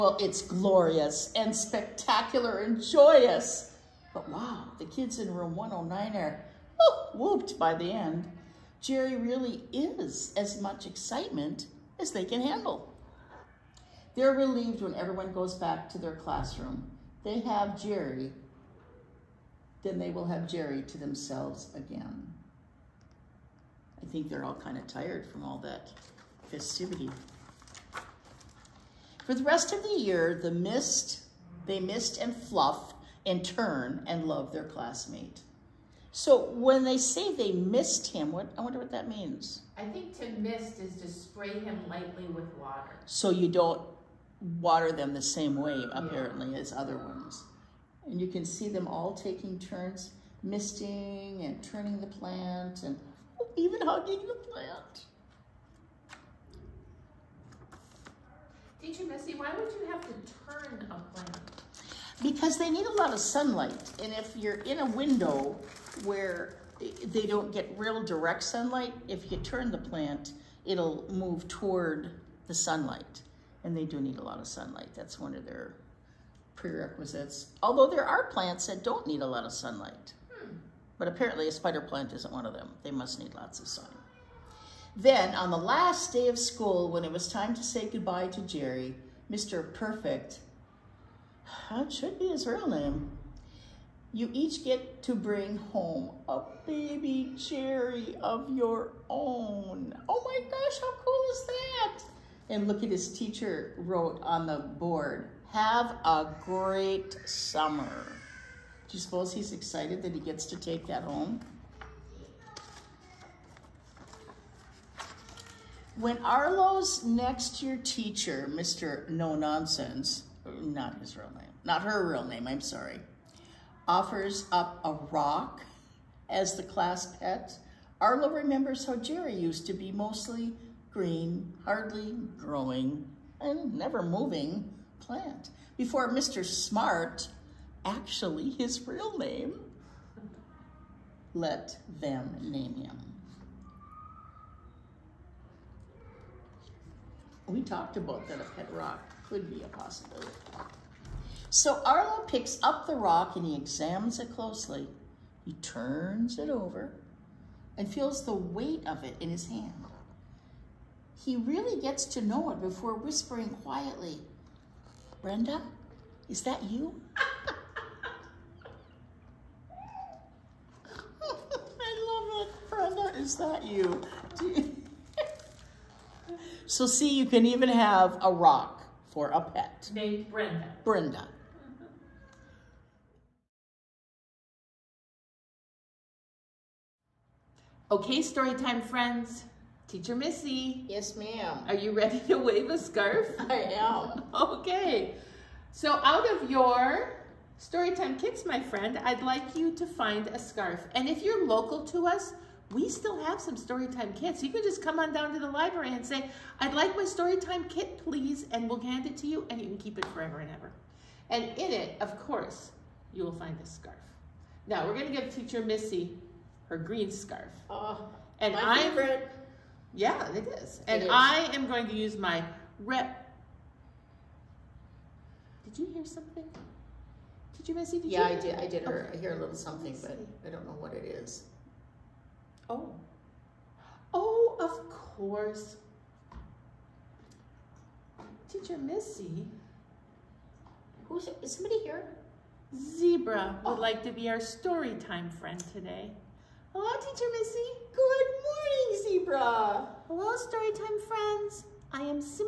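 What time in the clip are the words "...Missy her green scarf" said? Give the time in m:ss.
3:35.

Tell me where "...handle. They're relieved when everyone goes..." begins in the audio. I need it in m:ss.
0:12.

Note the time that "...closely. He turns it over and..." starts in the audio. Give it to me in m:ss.
2:34.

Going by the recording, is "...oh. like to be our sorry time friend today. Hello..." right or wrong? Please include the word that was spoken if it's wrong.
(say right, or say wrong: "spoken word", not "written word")
wrong: "story", not "sorry".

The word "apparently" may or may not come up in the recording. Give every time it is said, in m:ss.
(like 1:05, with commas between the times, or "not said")
0:45, 1:21.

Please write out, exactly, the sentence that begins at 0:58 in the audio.
Teacher Missy, why would you have to turn a plant?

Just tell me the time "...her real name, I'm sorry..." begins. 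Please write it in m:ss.
2:01.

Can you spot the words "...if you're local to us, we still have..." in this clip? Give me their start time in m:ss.
3:21.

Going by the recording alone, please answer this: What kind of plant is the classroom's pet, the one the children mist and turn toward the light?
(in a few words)
Spider plant.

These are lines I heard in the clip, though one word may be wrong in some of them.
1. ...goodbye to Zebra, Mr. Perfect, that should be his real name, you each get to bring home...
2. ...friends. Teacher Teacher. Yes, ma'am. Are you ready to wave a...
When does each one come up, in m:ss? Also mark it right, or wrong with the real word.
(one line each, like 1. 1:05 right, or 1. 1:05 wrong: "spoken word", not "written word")
1. 1:27 wrong: "Jerry", not "Zebra"
2. 3:08 wrong: "Missy", not "Teacher".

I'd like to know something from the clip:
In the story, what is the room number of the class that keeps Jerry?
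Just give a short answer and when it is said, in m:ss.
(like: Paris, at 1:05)
109, at 0:05.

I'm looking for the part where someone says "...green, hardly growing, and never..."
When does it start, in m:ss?
2:10.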